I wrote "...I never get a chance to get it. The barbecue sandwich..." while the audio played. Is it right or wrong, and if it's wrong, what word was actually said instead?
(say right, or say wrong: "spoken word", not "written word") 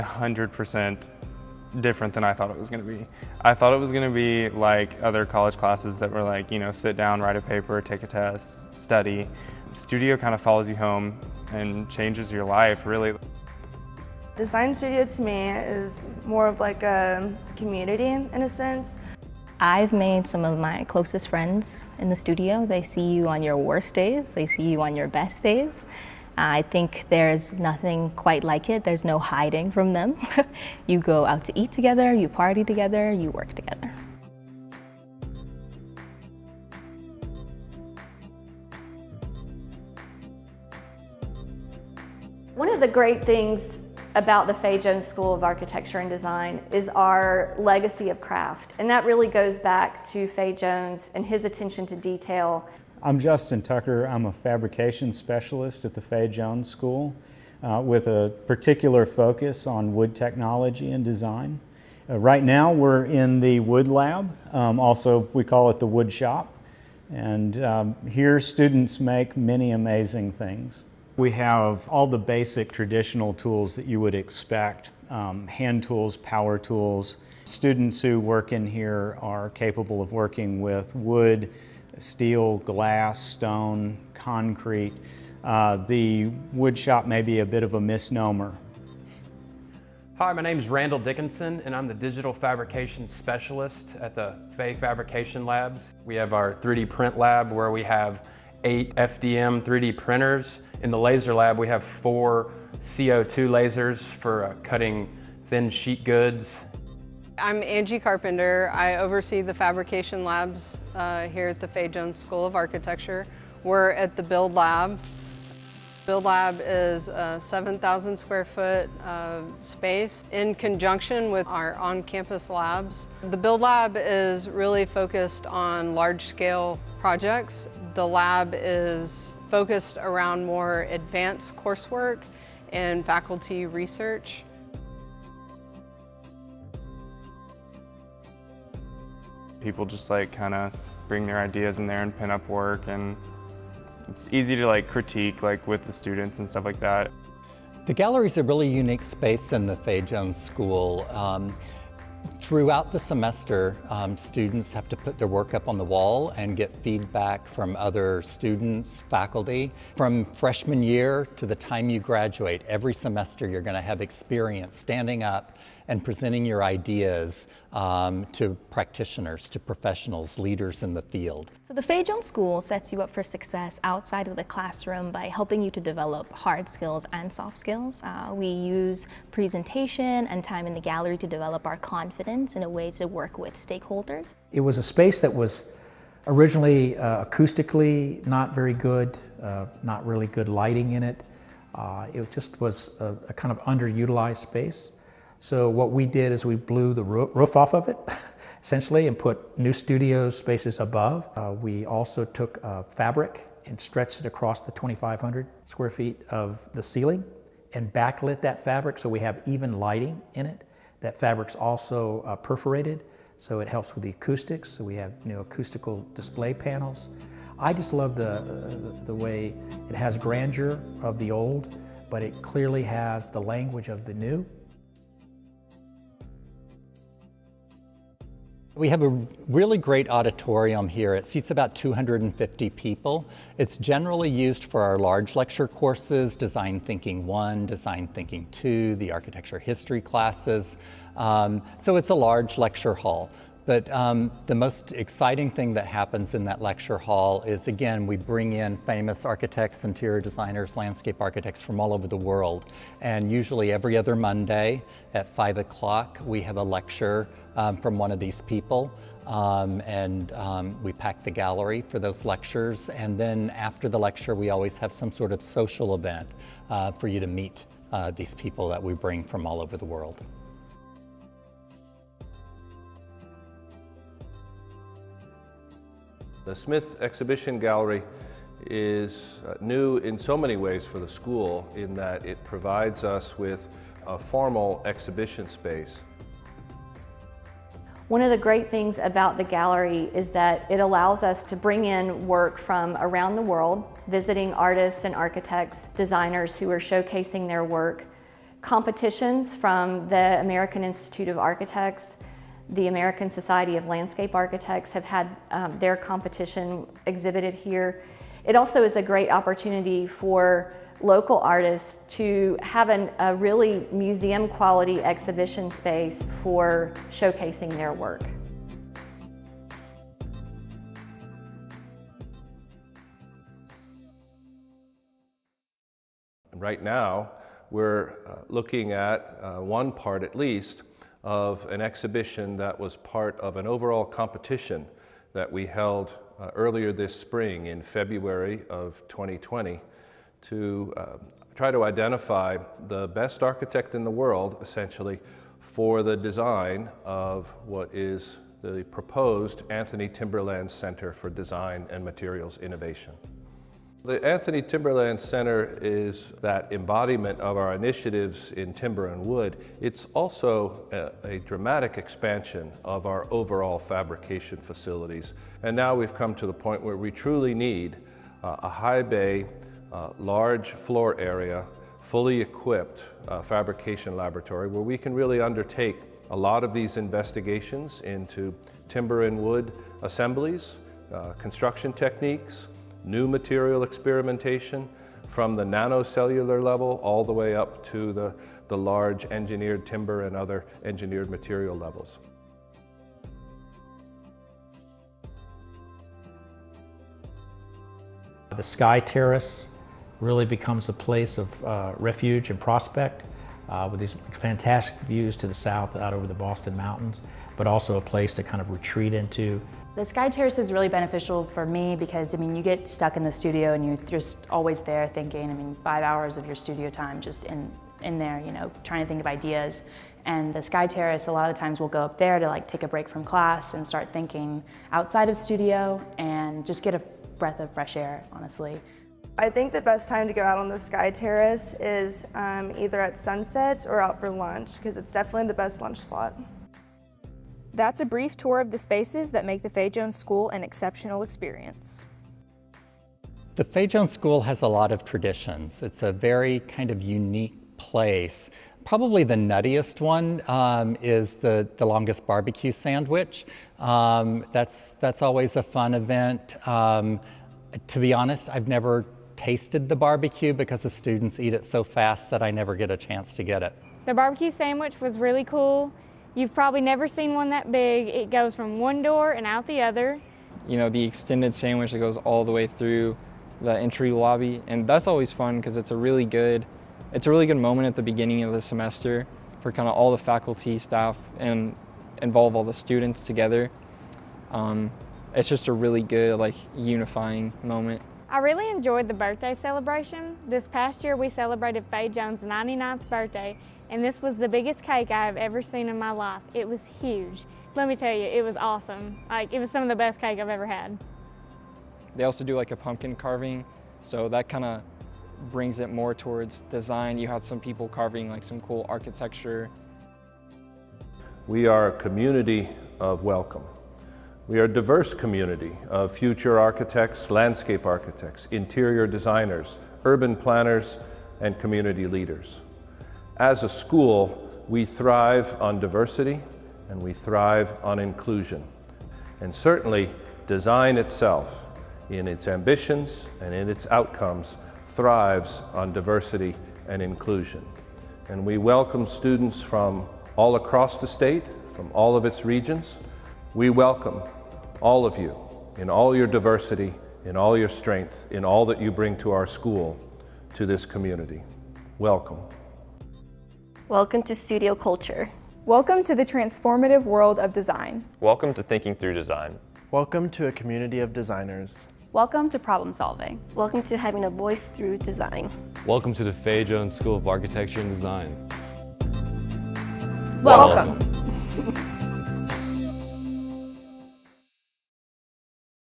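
right.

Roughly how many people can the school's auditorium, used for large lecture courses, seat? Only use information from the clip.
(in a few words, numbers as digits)
250.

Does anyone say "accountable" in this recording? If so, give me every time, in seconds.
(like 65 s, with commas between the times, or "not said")
not said.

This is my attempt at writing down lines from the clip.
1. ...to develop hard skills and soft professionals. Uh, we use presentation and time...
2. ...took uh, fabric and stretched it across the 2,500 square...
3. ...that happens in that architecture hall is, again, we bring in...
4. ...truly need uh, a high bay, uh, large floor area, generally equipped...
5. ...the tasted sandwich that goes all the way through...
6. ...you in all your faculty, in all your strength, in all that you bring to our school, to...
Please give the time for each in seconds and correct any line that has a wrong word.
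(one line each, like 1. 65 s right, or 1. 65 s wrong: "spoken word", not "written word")
1. 175 s wrong: "skills", not "professionals"
2. 202 s right
3. 245 s wrong: "lecture", not "architecture"
4. 367 s wrong: "fully", not "generally"
5. 470 s wrong: "extended", not "tasted"
6. 545 s wrong: "diversity", not "faculty".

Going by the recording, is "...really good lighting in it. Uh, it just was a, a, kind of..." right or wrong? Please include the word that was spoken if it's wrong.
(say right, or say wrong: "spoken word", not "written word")
right.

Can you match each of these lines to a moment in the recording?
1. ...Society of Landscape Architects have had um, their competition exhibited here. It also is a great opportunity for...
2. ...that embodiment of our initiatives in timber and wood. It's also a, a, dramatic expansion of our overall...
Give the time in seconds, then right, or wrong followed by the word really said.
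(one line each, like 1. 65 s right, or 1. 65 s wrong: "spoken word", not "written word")
1. 303 s right
2. 356 s right.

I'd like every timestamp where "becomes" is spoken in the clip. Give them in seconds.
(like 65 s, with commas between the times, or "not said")
400 s.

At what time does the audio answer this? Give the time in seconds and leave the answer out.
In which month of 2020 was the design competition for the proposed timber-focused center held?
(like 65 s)
337 s.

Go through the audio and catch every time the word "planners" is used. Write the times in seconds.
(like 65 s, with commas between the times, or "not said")
520 s.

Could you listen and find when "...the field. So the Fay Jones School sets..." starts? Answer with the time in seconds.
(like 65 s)
170 s.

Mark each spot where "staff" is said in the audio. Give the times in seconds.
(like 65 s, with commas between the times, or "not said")
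480 s.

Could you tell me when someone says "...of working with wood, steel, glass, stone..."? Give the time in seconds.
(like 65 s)
80 s.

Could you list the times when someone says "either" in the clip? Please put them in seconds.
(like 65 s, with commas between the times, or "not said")
432 s.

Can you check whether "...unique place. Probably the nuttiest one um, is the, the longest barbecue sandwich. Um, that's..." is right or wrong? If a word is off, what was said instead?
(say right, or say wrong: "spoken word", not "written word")
right.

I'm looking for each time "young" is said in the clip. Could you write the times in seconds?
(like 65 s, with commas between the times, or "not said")
not said.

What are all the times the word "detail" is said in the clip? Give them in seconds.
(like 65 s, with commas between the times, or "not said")
51 s.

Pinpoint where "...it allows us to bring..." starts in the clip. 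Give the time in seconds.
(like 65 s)
290 s.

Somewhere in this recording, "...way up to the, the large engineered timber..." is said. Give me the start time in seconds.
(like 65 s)
387 s.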